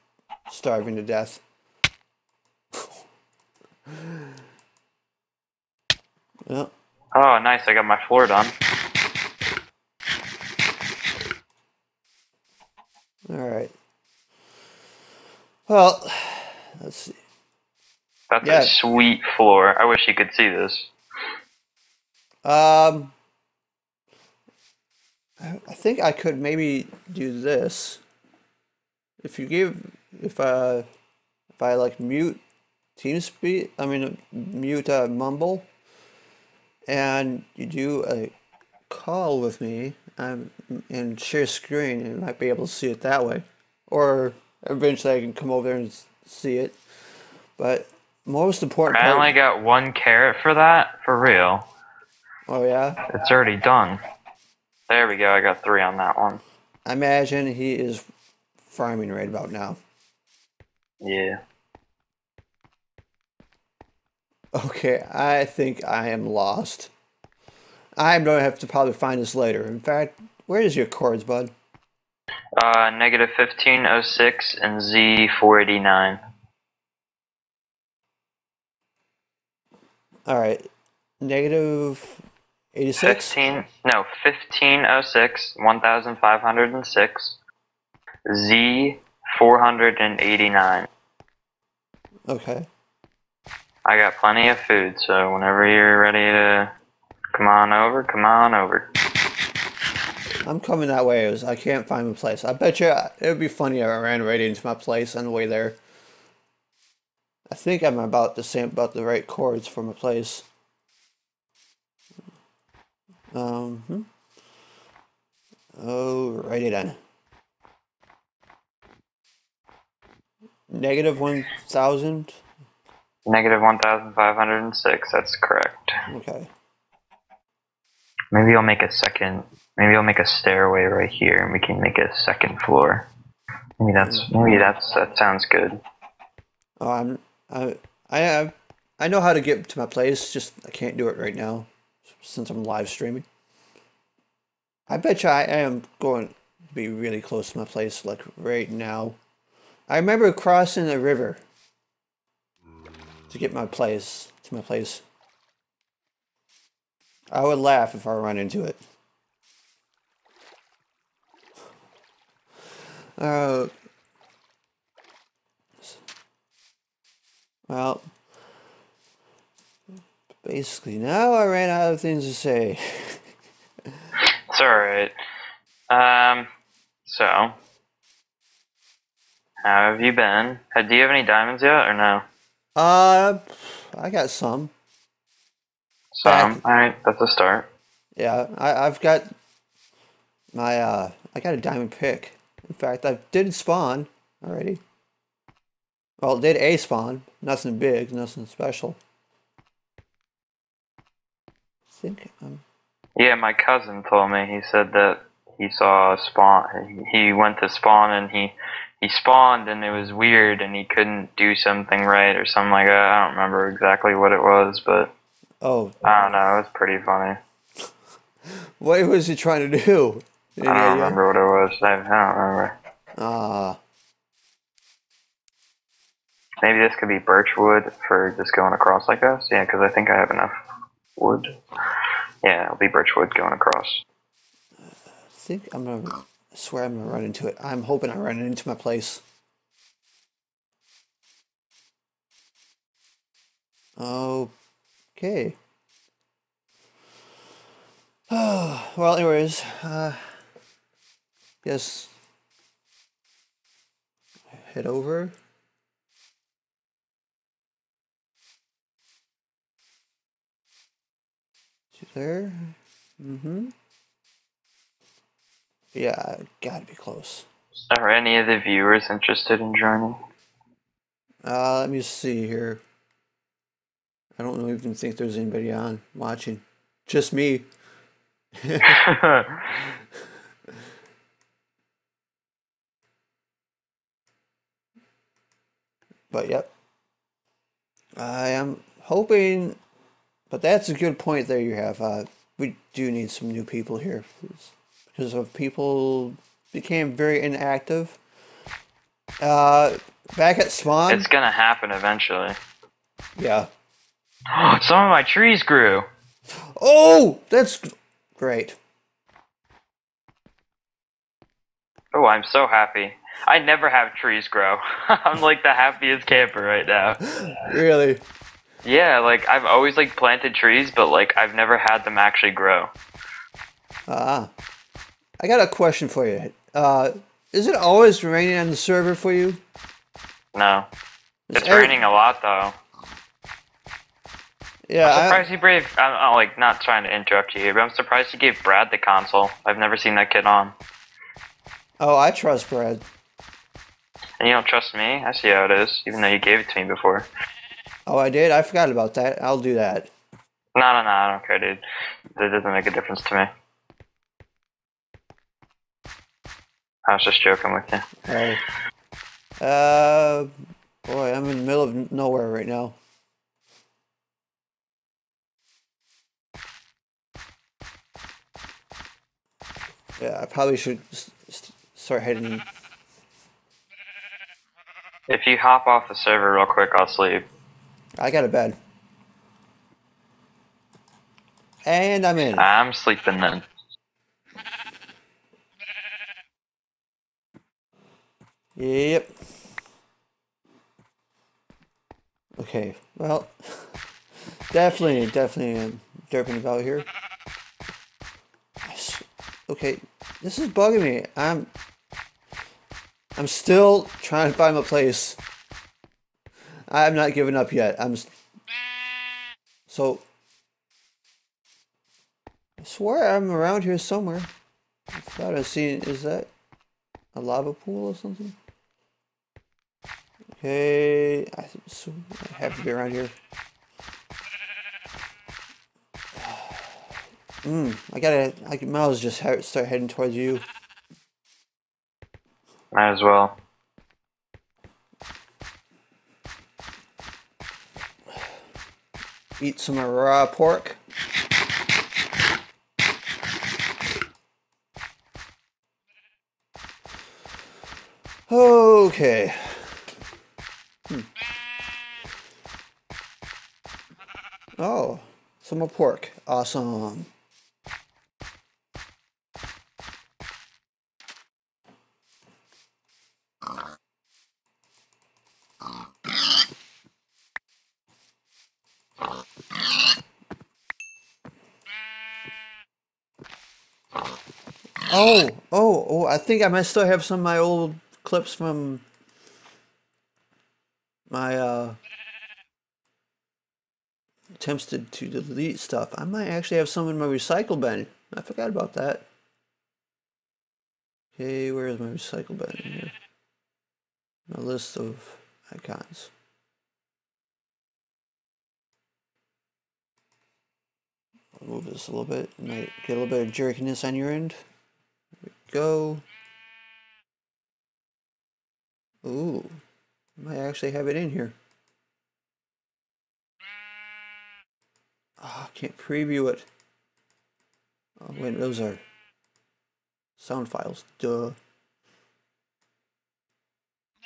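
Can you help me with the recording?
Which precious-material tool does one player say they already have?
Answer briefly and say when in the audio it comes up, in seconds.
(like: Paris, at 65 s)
diamond pick, at 191 s.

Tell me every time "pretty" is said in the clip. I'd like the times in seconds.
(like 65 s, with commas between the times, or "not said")
216 s.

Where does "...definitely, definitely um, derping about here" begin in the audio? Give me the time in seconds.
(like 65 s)
394 s.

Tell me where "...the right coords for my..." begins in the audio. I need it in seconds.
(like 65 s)
108 s.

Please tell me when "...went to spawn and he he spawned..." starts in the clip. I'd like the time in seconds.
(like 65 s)
207 s.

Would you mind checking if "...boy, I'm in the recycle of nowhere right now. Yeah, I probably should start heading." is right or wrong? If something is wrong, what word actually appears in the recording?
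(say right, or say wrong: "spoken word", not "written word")
wrong: "middle", not "recycle".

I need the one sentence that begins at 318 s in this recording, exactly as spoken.
Yeah, like I've always like planted trees, but like I've never had them actually grow.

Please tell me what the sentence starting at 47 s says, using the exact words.
But most important, I part, only got one carrot for that for real.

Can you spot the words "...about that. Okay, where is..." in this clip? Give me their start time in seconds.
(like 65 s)
488 s.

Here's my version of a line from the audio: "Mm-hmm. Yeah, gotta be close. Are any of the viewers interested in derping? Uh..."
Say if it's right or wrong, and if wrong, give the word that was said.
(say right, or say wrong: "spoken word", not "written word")
wrong: "joining", not "derping".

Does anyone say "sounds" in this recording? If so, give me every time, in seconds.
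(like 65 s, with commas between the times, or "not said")
135 s, 520 s.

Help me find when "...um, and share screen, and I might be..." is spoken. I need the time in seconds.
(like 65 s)
40 s.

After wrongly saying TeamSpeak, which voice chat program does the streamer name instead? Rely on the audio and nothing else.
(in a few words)
Mumble.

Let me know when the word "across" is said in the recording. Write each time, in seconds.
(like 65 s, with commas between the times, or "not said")
228 s, 233 s.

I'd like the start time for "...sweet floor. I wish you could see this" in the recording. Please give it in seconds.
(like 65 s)
18 s.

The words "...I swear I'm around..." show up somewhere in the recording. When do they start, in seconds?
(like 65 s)
412 s.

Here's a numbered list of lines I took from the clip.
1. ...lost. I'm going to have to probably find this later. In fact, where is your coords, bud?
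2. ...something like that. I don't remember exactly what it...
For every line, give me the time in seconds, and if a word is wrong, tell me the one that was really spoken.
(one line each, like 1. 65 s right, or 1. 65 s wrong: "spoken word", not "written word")
1. 66 s right
2. 212 s right.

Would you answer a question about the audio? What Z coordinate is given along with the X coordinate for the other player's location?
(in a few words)
489.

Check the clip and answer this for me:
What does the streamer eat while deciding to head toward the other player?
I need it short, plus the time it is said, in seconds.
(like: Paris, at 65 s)
raw pork, at 439 s.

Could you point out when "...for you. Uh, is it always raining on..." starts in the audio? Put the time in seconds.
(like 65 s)
326 s.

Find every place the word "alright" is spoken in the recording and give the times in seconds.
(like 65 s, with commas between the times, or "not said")
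13 s, 80 s, 174 s.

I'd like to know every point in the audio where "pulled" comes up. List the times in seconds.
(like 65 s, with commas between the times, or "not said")
not said.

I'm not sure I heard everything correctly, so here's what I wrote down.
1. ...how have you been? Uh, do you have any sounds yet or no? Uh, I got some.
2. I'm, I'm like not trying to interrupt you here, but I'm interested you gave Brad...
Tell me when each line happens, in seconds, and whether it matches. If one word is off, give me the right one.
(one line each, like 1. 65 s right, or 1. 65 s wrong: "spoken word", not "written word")
1. 179 s wrong: "diamonds", not "sounds"
2. 335 s wrong: "surprised", not "interested".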